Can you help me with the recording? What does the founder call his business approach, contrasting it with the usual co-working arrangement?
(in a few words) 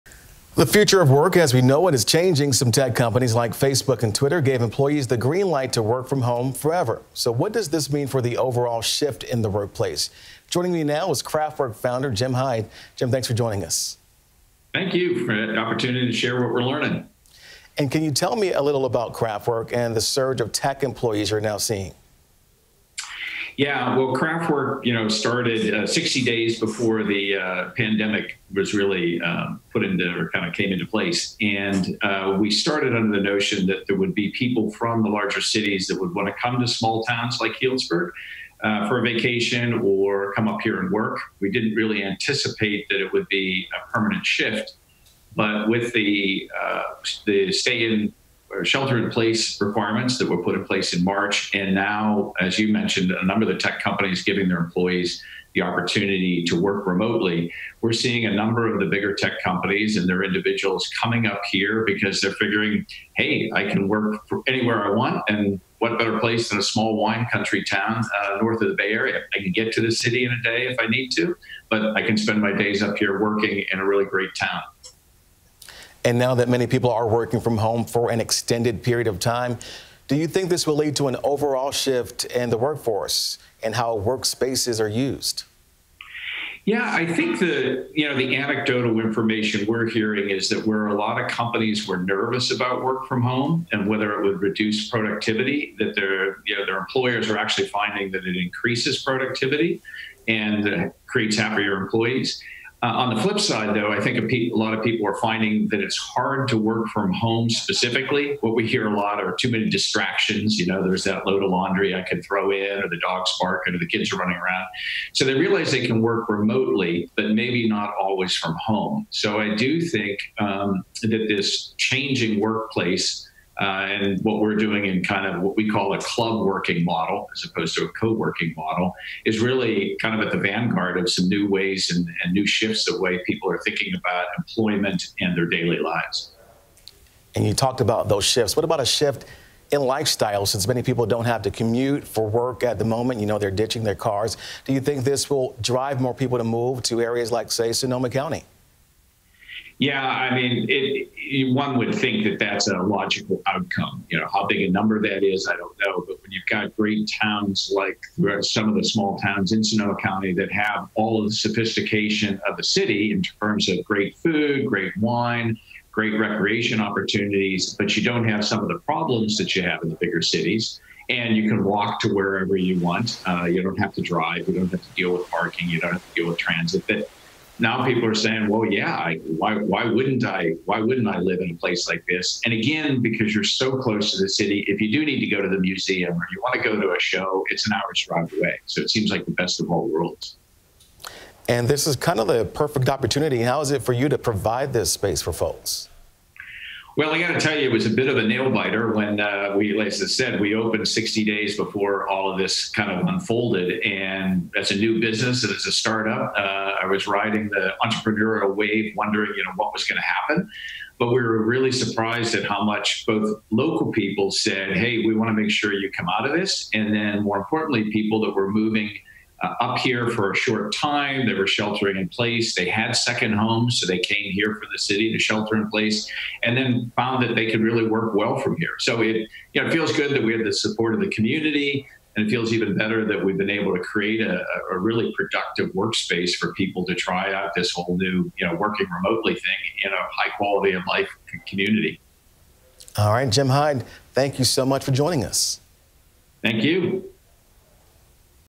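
club working model.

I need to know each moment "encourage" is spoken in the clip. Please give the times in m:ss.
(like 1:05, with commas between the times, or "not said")
not said.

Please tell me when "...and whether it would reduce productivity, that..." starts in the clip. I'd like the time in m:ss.
1:33.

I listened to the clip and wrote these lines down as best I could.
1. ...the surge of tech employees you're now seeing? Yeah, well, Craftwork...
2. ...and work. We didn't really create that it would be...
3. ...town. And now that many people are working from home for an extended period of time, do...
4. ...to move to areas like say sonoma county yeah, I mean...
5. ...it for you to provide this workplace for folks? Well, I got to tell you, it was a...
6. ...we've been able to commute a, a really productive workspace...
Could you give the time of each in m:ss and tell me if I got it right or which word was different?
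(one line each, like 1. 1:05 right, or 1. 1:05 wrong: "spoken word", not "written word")
1. 0:19 right
2. 0:40 wrong: "anticipate", not "create"
3. 1:14 right
4. 2:26 right
5. 3:13 wrong: "space", not "workplace"
6. 3:53 wrong: "create", not "commute".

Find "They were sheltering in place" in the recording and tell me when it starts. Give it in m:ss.
3:41.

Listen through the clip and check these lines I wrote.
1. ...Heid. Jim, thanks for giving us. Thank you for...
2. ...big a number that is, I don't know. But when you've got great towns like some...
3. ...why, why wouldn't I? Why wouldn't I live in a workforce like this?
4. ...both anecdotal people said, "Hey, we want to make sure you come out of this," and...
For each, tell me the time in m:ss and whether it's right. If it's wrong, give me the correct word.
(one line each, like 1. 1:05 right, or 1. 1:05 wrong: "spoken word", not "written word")
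1. 0:12 wrong: "joining", not "giving"
2. 2:34 right
3. 2:59 wrong: "place", not "workforce"
4. 3:33 wrong: "local", not "anecdotal".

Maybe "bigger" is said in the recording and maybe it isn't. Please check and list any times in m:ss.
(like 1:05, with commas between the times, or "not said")
0:58, 2:49.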